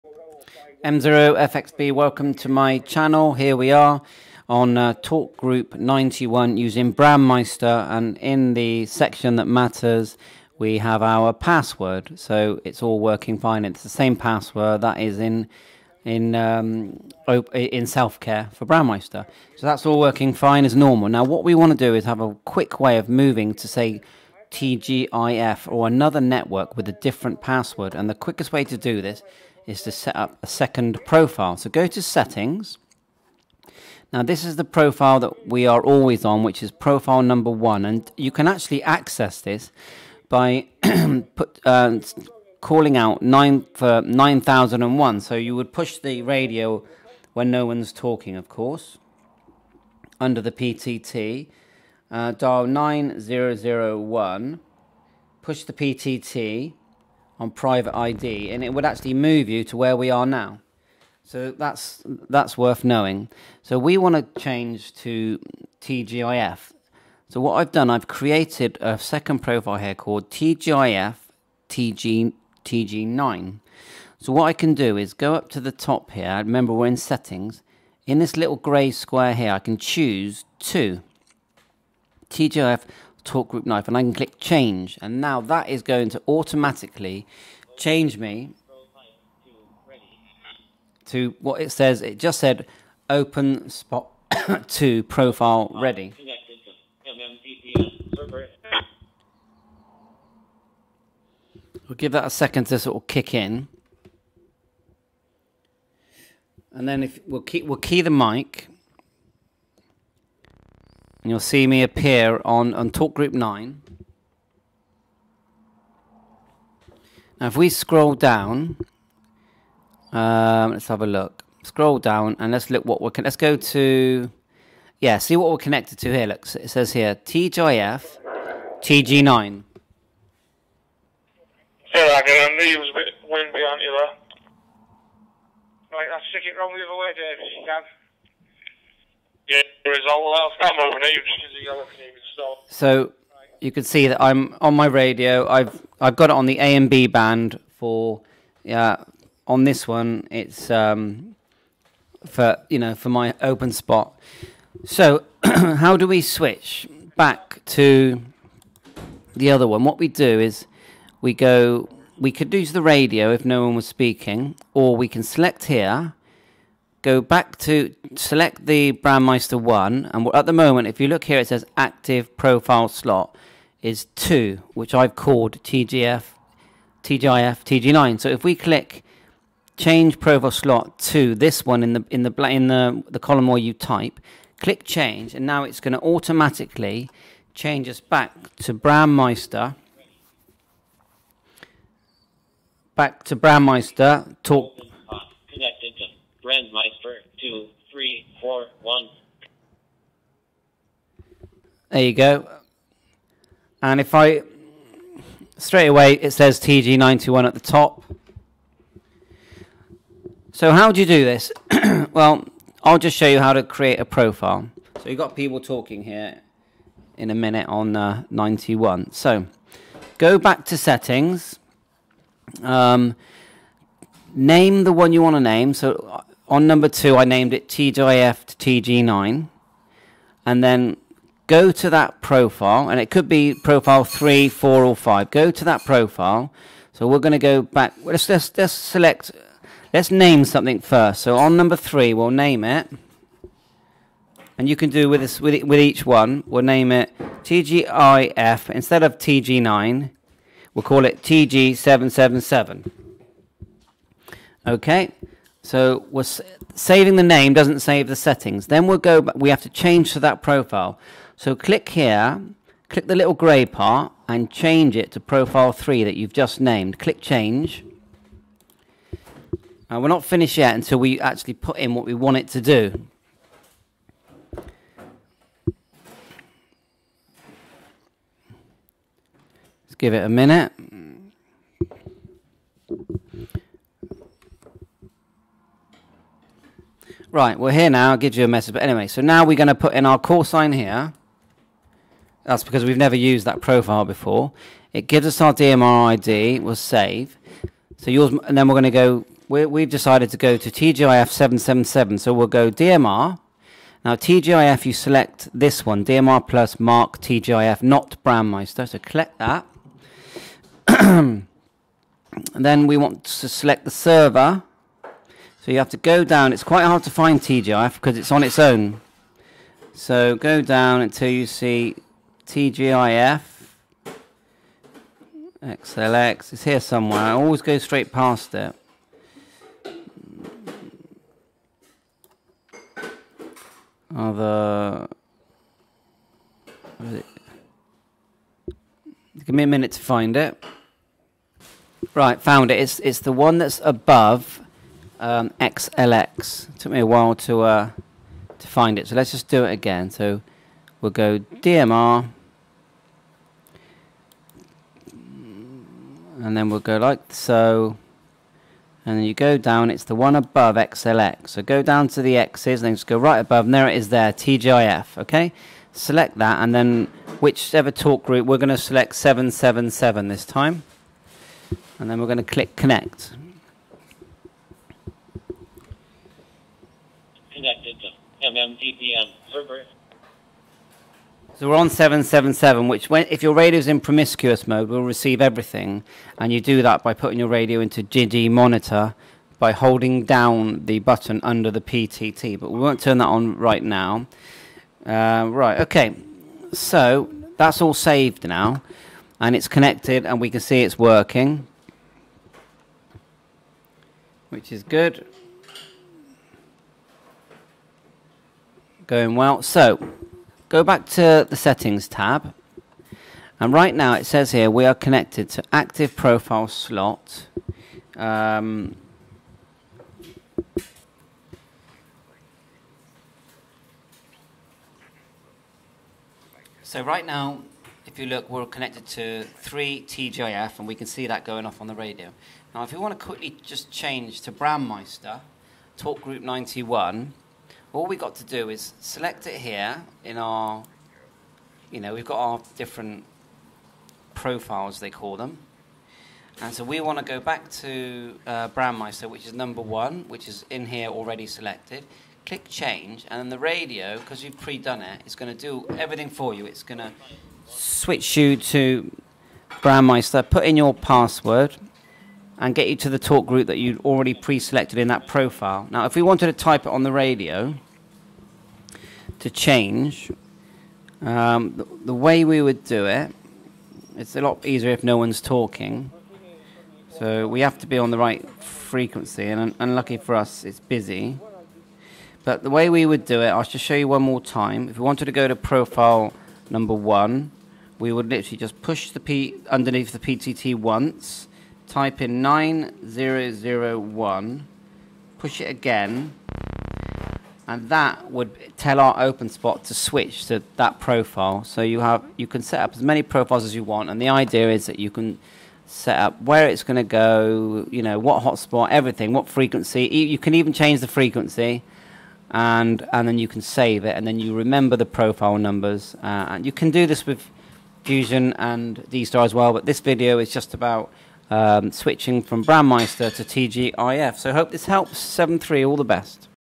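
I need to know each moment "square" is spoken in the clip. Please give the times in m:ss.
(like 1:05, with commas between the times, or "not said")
1:18.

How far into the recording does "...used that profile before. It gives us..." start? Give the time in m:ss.
4:53.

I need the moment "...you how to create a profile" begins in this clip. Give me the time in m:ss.
3:33.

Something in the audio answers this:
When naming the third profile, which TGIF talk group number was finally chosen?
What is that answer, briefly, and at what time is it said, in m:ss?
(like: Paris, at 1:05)
777, at 4:11.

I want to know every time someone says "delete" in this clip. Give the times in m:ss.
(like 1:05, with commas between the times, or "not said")
not said.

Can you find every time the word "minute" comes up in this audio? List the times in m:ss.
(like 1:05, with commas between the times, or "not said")
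3:37, 4:40, 5:39.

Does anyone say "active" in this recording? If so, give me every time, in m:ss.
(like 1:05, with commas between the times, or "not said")
2:51, 6:55.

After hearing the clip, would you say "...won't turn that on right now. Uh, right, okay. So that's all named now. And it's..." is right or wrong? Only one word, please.
wrong.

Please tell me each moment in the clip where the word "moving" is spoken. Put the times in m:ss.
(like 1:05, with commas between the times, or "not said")
0:23.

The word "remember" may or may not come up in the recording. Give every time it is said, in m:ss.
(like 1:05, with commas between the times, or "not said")
1:16, 8:34.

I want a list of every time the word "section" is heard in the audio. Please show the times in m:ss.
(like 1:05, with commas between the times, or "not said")
0:08.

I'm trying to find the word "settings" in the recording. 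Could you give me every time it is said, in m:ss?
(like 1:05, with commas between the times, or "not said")
0:32, 1:16, 3:40, 4:18, 6:51.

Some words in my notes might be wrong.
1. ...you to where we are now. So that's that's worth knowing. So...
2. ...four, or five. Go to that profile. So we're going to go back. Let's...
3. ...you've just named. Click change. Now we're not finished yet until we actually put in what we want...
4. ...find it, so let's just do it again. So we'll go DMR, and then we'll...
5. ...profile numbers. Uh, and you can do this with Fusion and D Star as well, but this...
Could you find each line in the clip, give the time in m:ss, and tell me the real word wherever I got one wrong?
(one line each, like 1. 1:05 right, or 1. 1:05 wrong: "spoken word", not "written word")
1. 0:59 right
2. 3:54 right
3. 4:26 right
4. 5:48 right
5. 8:35 right.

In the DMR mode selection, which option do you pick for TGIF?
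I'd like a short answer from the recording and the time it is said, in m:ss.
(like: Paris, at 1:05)
DMR plus, at 5:06.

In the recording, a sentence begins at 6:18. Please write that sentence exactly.
So we're on 777, which when, if your radio's in promiscuous mode, will receive everything.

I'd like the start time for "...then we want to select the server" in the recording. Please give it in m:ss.
5:12.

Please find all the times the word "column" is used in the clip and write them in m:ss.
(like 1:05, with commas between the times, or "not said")
3:03.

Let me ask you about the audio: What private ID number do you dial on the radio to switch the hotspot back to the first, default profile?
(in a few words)
9001.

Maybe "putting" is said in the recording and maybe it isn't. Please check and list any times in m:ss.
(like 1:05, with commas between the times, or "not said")
6:27.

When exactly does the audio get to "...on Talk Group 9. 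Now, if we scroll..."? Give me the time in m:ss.
1:52.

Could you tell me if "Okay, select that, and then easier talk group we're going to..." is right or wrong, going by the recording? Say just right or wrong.
wrong.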